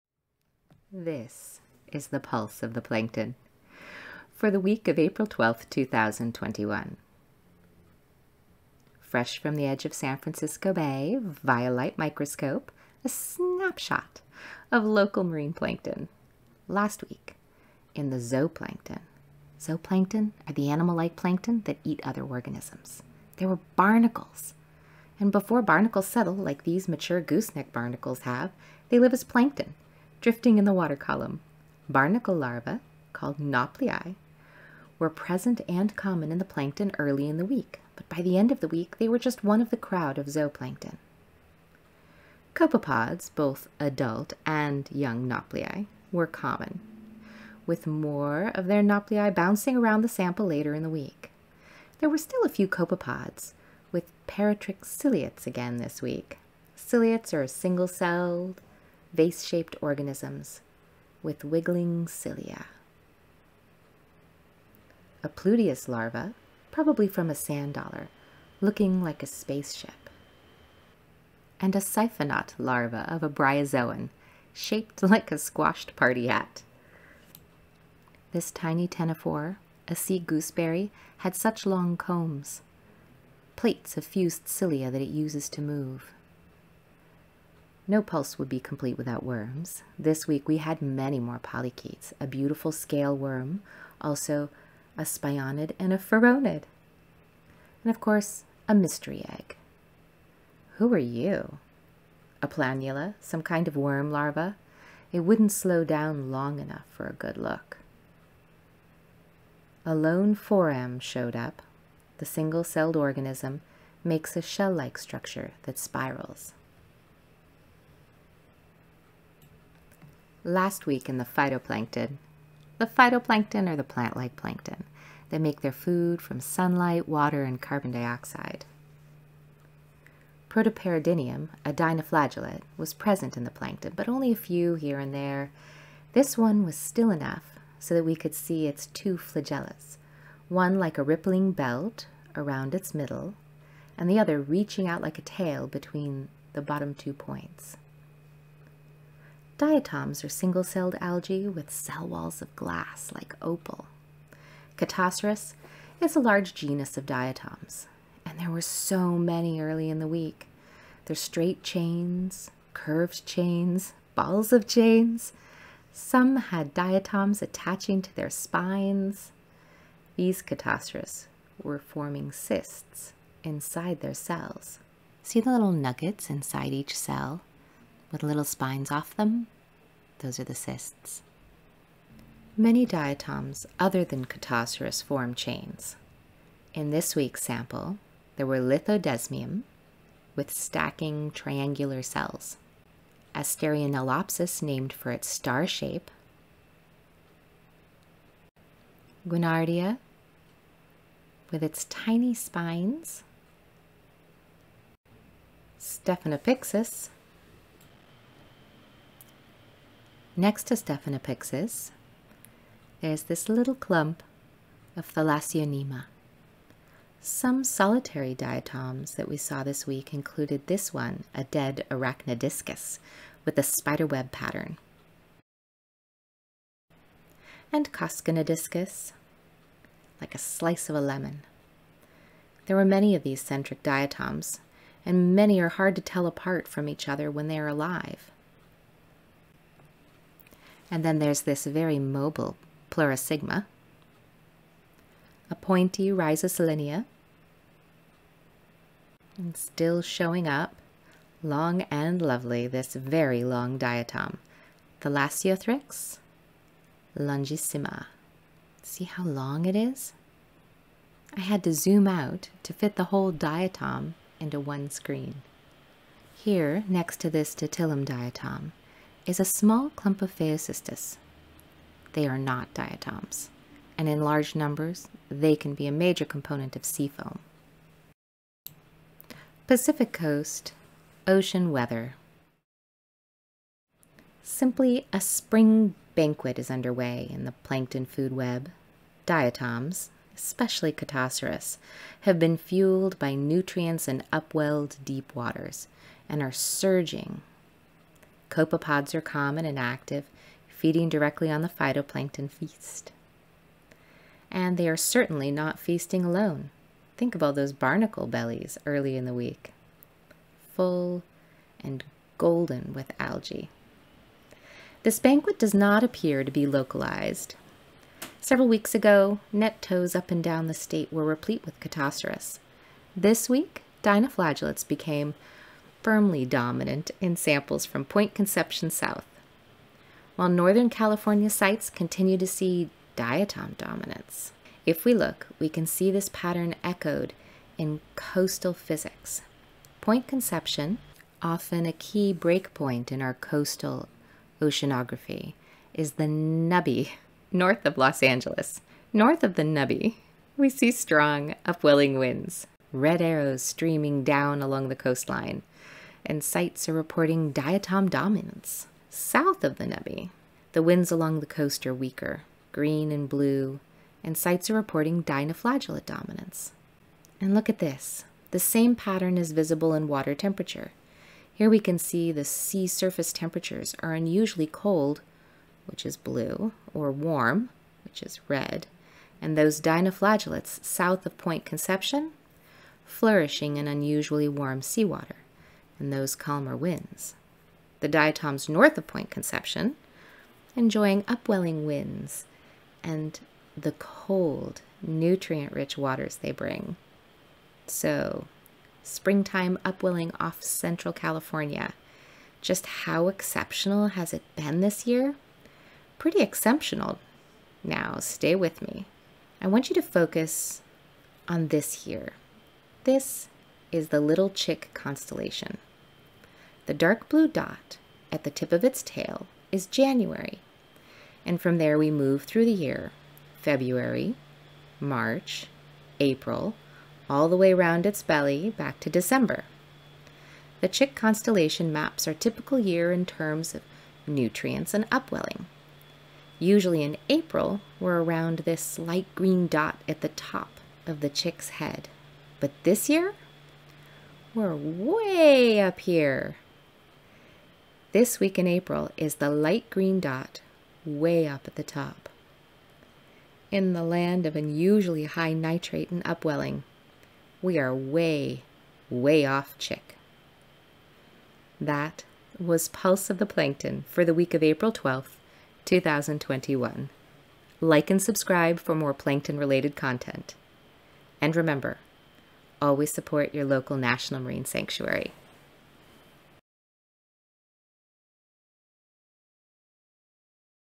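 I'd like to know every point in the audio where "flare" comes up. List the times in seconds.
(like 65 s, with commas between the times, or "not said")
not said.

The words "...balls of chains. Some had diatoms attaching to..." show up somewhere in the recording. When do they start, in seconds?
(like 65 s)
164 s.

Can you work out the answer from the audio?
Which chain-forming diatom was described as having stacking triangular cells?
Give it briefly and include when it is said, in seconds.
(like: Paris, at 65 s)
Lithodesmium, at 188 s.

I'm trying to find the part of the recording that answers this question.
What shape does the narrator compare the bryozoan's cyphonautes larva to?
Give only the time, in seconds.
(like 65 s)
75 s.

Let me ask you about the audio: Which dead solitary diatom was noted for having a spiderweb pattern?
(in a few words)
Arachnoidiscus.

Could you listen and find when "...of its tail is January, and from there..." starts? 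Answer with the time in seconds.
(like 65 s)
418 s.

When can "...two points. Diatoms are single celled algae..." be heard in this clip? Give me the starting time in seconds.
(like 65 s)
146 s.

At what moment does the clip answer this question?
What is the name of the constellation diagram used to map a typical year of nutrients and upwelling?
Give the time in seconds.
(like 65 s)
414 s.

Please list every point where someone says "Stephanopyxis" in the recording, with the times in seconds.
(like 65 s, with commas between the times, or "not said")
205 s, 210 s.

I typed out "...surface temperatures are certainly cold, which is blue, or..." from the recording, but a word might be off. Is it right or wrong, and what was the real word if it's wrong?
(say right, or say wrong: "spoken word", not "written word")
wrong: "unusually", not "certainly".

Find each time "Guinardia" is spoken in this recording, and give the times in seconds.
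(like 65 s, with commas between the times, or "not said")
199 s.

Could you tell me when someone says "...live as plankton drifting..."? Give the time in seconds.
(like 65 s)
28 s.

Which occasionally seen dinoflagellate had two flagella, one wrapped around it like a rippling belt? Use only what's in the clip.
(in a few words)
Protoperidinium.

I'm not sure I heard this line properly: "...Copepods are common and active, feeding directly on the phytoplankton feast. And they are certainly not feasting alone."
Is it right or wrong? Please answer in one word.
right.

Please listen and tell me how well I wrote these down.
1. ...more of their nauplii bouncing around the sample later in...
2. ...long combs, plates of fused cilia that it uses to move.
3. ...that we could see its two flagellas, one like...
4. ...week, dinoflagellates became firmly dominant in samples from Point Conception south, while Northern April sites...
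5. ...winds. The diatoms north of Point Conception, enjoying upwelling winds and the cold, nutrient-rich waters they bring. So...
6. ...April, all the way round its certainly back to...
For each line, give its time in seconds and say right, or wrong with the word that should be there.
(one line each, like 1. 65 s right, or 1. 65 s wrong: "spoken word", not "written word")
1. 47 s right
2. 81 s right
3. 137 s right
4. 323 s wrong: "California", not "April"
5. 386 s right
6. 426 s wrong: "belly", not "certainly".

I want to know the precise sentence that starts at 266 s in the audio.
Here, next to this Ditylum diatom, is a small clump of phaeocystis.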